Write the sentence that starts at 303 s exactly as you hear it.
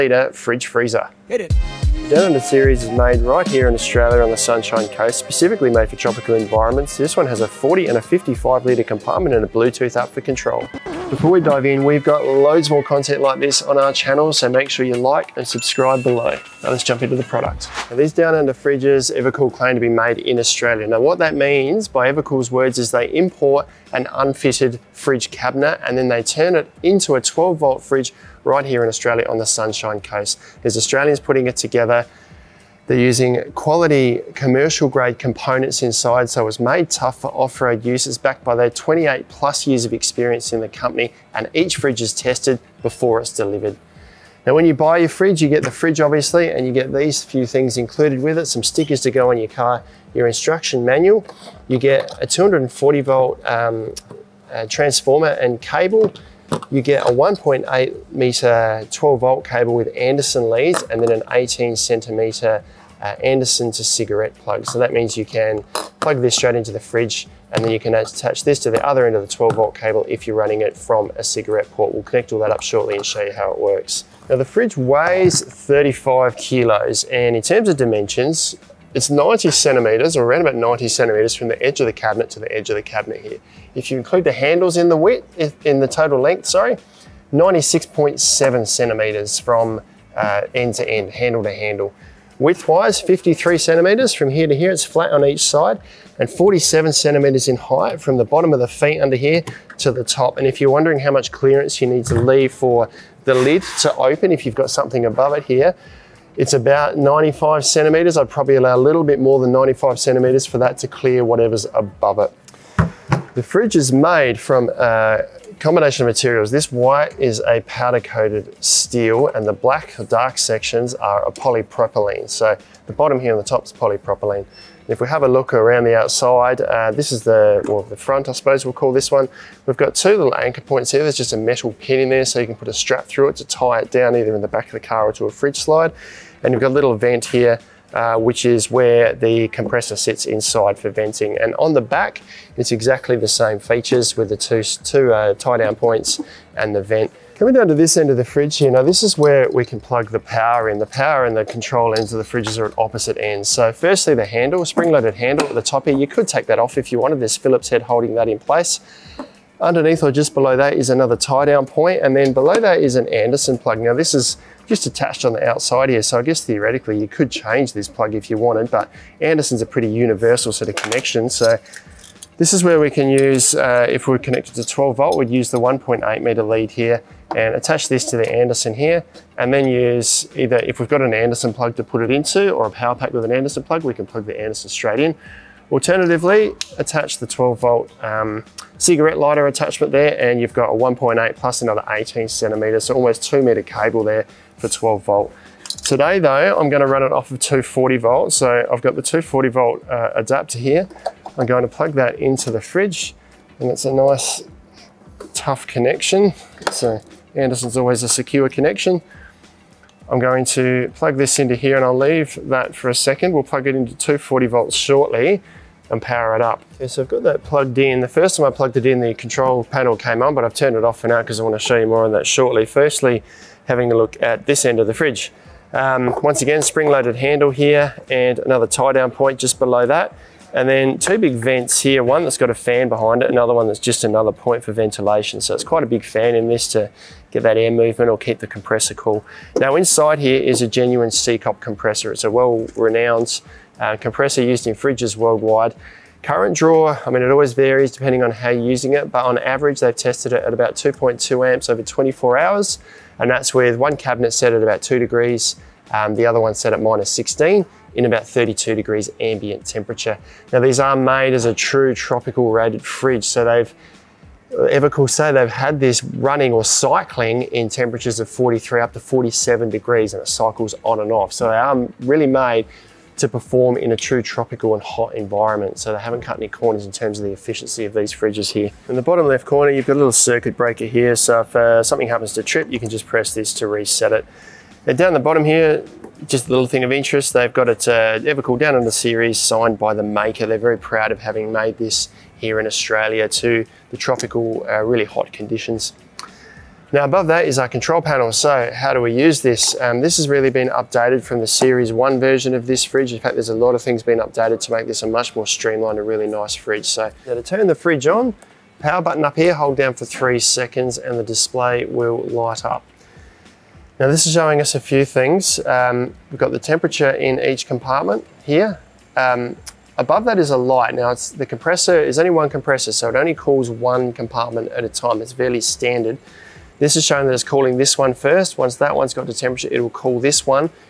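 In fact, there's a lot of things being updated to make this a much more streamlined a really nice fridge.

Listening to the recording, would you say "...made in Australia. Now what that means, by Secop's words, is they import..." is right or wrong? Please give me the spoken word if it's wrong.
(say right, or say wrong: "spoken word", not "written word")
wrong: "EvaKool", not "Secop".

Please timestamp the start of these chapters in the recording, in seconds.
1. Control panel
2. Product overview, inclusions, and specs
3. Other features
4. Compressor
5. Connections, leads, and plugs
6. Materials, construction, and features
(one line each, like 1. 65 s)
1. 296 s
2. 17 s
3. 278 s
4. 229 s
5. 161 s
6. 112 s.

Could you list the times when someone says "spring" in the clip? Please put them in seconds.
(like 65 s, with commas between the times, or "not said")
154 s, 226 s.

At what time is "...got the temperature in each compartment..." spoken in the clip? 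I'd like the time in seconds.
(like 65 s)
316 s.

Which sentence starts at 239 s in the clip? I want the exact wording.
Now inside here is a genuine Secop compressor.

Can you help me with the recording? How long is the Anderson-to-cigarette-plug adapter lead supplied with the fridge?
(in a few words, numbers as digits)
18 centimeters.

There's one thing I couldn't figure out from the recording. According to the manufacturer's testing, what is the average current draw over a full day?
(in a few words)
2.2 amps.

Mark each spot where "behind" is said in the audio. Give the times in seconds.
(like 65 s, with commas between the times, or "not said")
232 s.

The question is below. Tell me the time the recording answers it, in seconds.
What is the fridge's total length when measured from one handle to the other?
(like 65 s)
87 s.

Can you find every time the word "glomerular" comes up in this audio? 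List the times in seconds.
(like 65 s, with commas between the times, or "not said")
not said.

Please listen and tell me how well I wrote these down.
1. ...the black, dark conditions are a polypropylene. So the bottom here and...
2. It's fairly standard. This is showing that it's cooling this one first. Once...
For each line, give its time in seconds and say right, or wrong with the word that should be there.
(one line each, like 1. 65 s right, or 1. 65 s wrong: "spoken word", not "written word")
1. 119 s wrong: "sections", not "conditions"
2. 325 s right.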